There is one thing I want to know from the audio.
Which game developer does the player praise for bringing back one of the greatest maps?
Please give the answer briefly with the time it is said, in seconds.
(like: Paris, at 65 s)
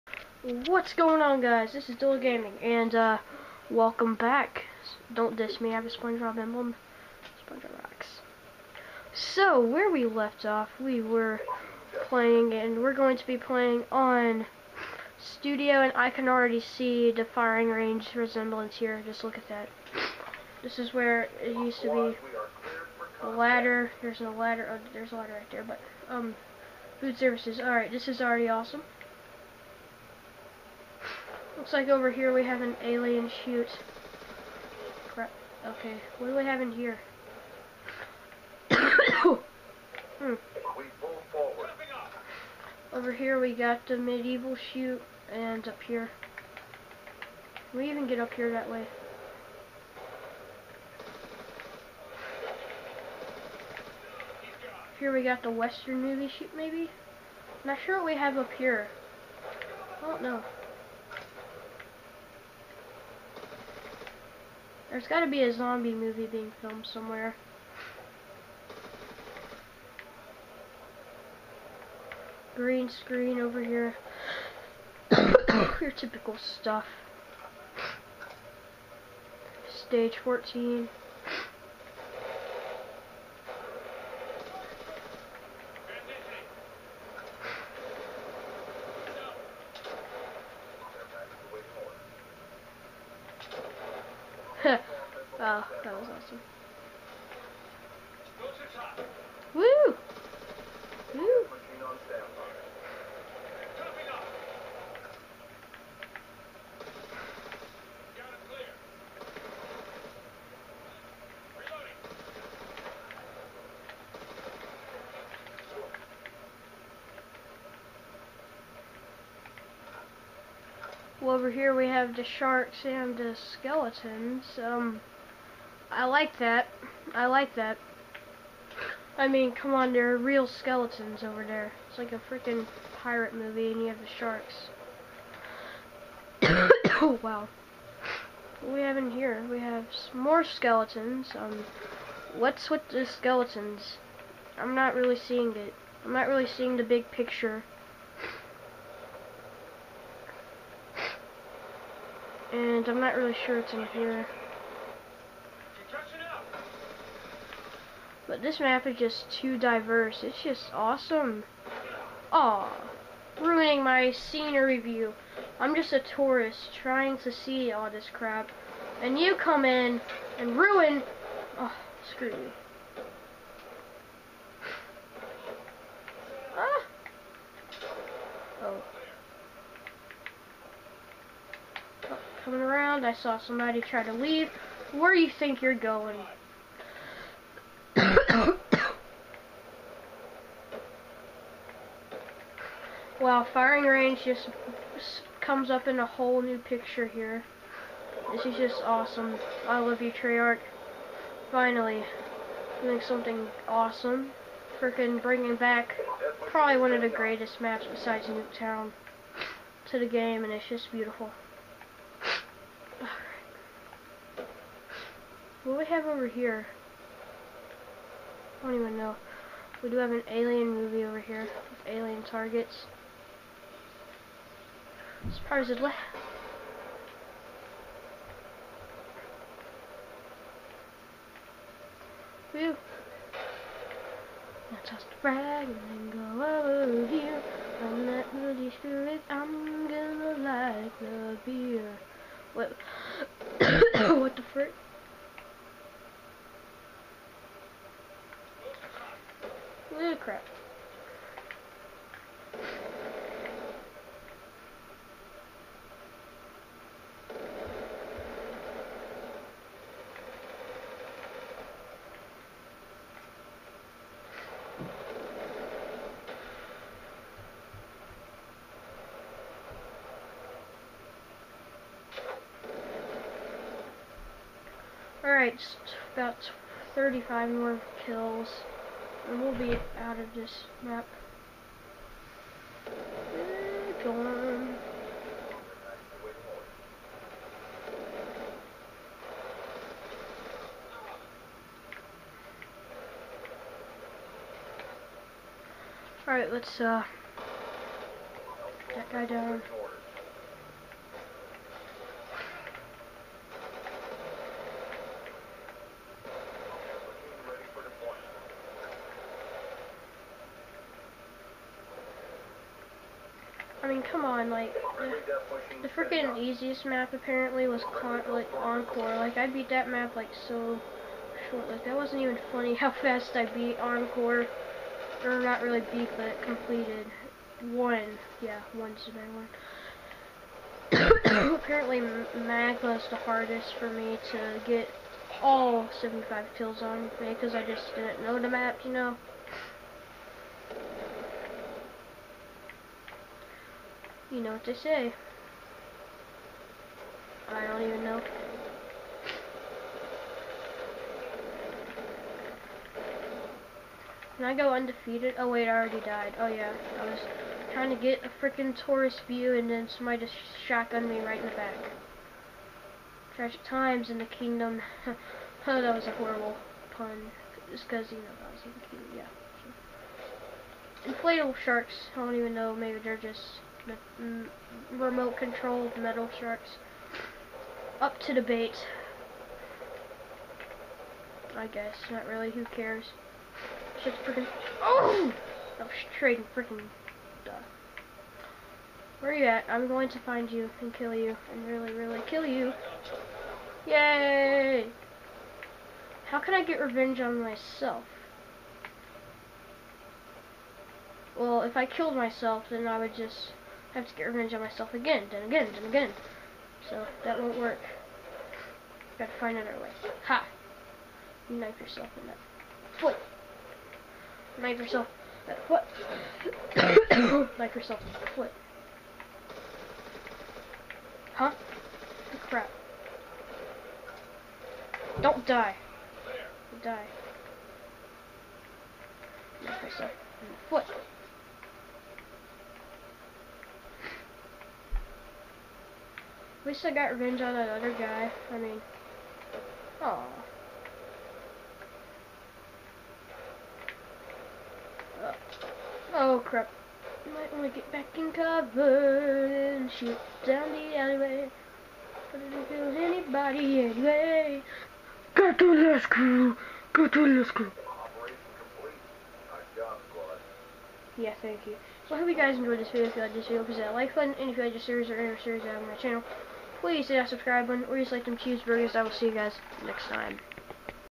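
Treyarch, at 200 s.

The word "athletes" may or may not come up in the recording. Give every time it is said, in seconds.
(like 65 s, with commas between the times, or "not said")
not said.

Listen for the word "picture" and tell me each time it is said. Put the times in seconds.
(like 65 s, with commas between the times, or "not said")
147 s, 196 s.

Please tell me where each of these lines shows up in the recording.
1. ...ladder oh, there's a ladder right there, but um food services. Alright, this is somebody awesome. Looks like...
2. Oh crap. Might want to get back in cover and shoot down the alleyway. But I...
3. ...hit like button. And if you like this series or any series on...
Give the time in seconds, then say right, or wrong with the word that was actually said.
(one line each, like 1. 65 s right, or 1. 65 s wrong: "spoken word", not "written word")
1. 24 s wrong: "already", not "somebody"
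2. 446 s right
3. 463 s right.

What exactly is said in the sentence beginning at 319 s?
Like, I beat that map, like, so short.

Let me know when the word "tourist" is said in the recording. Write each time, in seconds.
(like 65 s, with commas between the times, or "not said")
165 s, 358 s.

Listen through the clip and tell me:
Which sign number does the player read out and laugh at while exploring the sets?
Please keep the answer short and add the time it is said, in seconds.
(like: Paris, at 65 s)
14, at 79 s.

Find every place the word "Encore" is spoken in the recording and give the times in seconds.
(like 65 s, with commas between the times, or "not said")
318 s, 323 s.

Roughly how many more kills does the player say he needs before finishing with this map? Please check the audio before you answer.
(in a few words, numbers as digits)
35.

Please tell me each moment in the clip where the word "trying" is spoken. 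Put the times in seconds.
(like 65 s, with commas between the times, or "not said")
166 s, 357 s.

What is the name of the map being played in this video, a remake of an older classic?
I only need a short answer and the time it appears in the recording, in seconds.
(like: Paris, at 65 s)
Studio, at 15 s.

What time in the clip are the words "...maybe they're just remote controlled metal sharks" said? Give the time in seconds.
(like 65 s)
372 s.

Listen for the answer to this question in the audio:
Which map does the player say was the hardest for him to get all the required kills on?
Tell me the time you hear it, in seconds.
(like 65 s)
332 s.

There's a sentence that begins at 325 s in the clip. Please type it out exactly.
Or not really beat, but completed.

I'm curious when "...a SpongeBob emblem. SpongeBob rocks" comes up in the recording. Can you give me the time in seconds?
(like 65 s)
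5 s.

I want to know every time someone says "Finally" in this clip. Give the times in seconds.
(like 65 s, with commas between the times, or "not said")
201 s.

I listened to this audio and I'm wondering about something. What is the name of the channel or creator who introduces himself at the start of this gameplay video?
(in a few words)
Dual Gaming.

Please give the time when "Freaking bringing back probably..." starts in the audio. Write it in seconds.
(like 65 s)
204 s.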